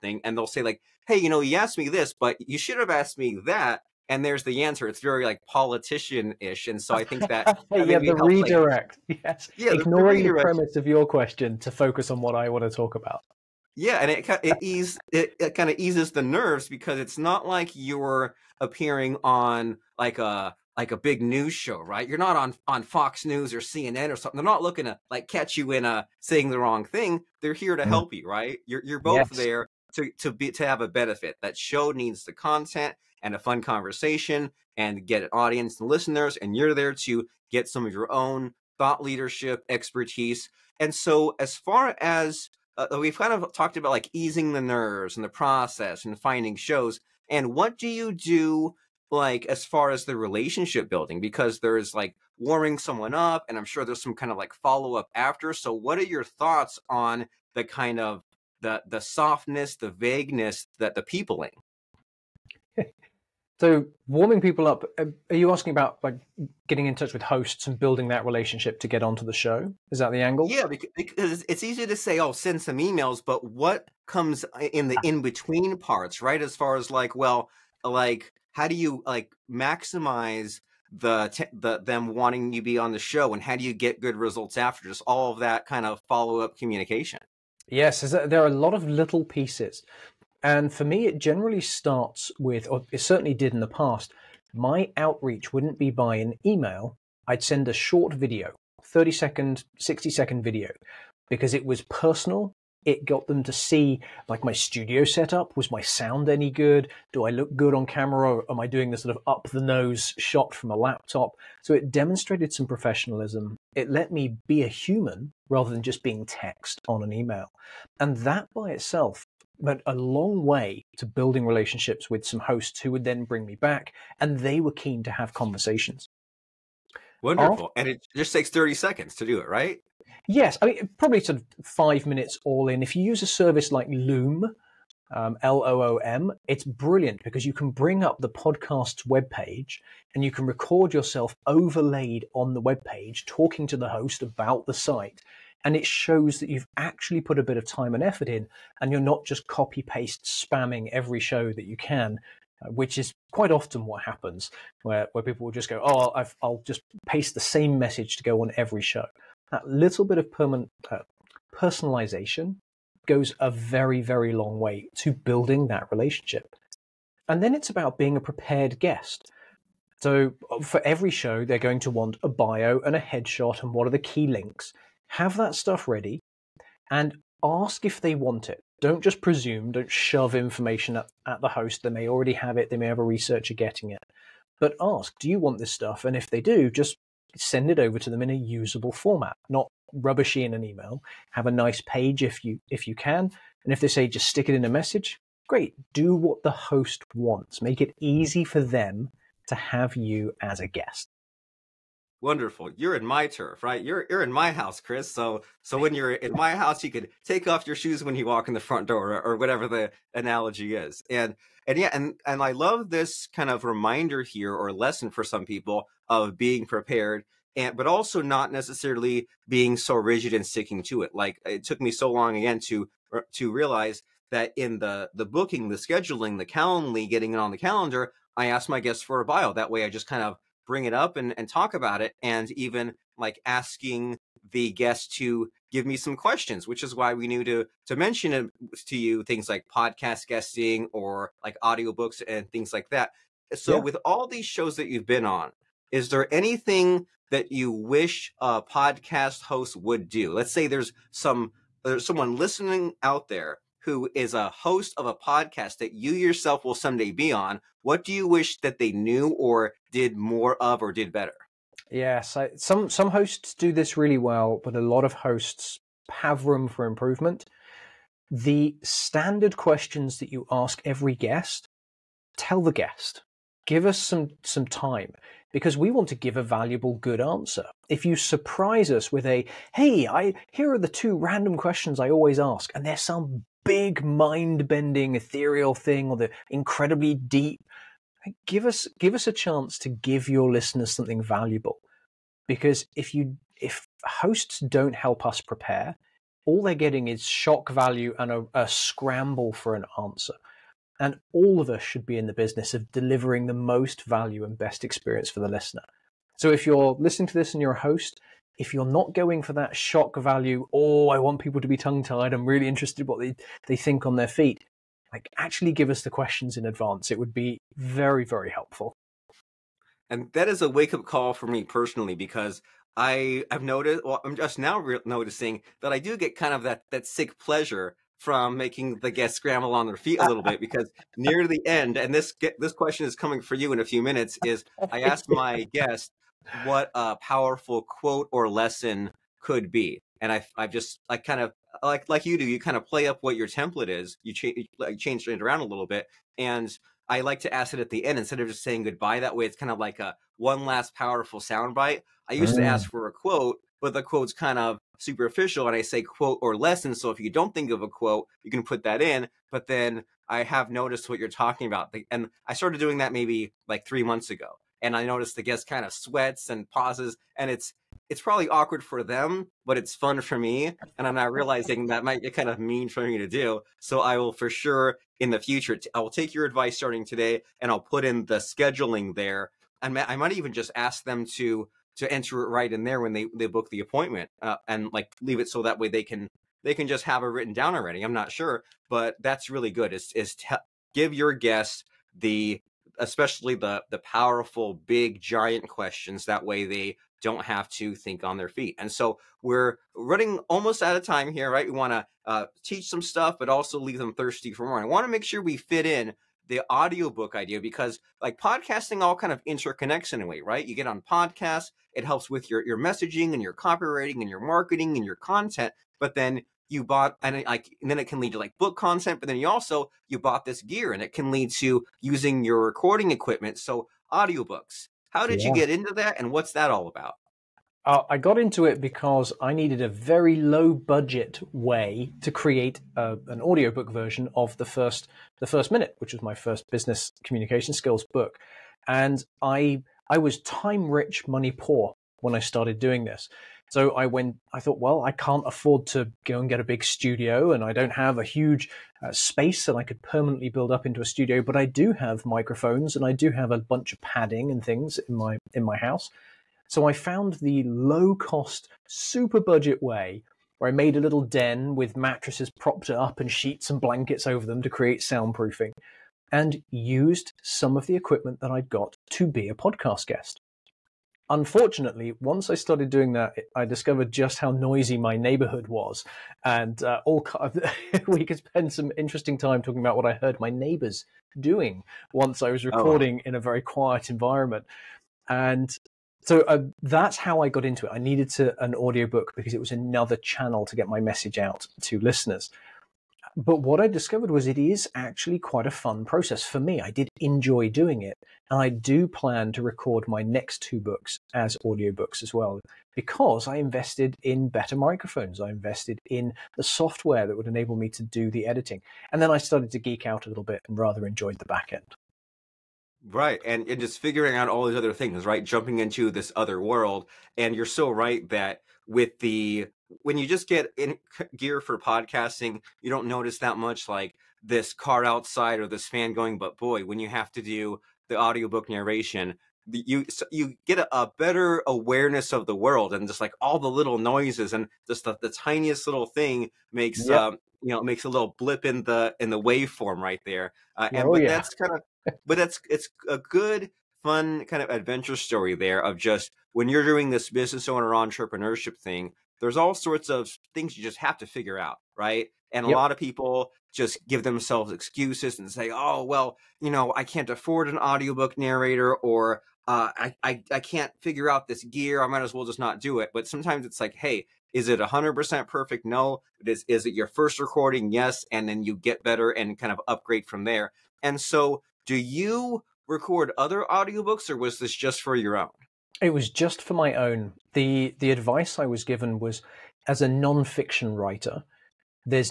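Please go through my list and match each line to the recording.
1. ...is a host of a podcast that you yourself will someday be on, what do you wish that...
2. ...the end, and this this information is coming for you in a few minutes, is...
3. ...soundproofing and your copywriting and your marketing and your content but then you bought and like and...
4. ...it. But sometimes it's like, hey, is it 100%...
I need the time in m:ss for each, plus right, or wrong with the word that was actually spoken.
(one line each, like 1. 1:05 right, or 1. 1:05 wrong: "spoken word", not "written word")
1. 4:14 right
2. 5:31 wrong: "question", not "information"
3. 6:52 wrong: "messaging", not "soundproofing"
4. 9:22 right.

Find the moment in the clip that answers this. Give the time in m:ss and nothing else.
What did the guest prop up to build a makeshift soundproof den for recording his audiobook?
7:41.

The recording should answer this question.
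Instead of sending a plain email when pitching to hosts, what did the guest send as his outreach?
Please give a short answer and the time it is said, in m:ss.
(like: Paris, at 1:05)
A short video, at 1:37.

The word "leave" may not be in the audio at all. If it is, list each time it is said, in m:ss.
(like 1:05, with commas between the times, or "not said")
6:25, 6:43.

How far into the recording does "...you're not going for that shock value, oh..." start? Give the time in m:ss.
5:08.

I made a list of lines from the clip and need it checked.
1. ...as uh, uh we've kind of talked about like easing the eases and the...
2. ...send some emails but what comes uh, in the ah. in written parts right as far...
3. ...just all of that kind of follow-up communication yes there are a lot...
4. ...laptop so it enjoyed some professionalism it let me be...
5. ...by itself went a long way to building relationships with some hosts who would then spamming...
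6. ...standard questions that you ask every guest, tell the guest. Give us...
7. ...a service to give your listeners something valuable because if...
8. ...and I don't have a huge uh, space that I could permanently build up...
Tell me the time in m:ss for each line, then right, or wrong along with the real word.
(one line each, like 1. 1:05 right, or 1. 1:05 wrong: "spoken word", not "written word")
1. 0:42 wrong: "nerves", not "eases"
2. 1:12 wrong: "between", not "written"
3. 1:24 right
4. 1:50 wrong: "demonstrated", not "enjoyed"
5. 1:58 wrong: "bring", not "spamming"
6. 4:28 right
7. 4:49 wrong: "chance", not "service"
8. 7:27 right.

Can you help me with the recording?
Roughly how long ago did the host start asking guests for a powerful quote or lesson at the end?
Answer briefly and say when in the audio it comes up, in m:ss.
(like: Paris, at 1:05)
3 months ago, at 6:03.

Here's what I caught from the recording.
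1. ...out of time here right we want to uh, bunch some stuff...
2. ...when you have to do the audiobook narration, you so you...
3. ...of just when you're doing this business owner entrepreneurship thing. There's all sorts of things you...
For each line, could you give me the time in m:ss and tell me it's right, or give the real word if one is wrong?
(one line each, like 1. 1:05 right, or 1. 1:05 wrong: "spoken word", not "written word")
1. 6:40 wrong: "teach", not "bunch"
2. 8:46 right
3. 9:05 right.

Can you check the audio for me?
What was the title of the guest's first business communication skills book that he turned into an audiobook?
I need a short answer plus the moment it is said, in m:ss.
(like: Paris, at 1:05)
The First Minute, at 7:15.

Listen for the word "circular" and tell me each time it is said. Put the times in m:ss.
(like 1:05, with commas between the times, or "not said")
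not said.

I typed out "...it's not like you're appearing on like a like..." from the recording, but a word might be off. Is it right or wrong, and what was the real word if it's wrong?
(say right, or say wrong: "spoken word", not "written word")
right.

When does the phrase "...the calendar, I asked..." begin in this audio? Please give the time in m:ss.
3:47.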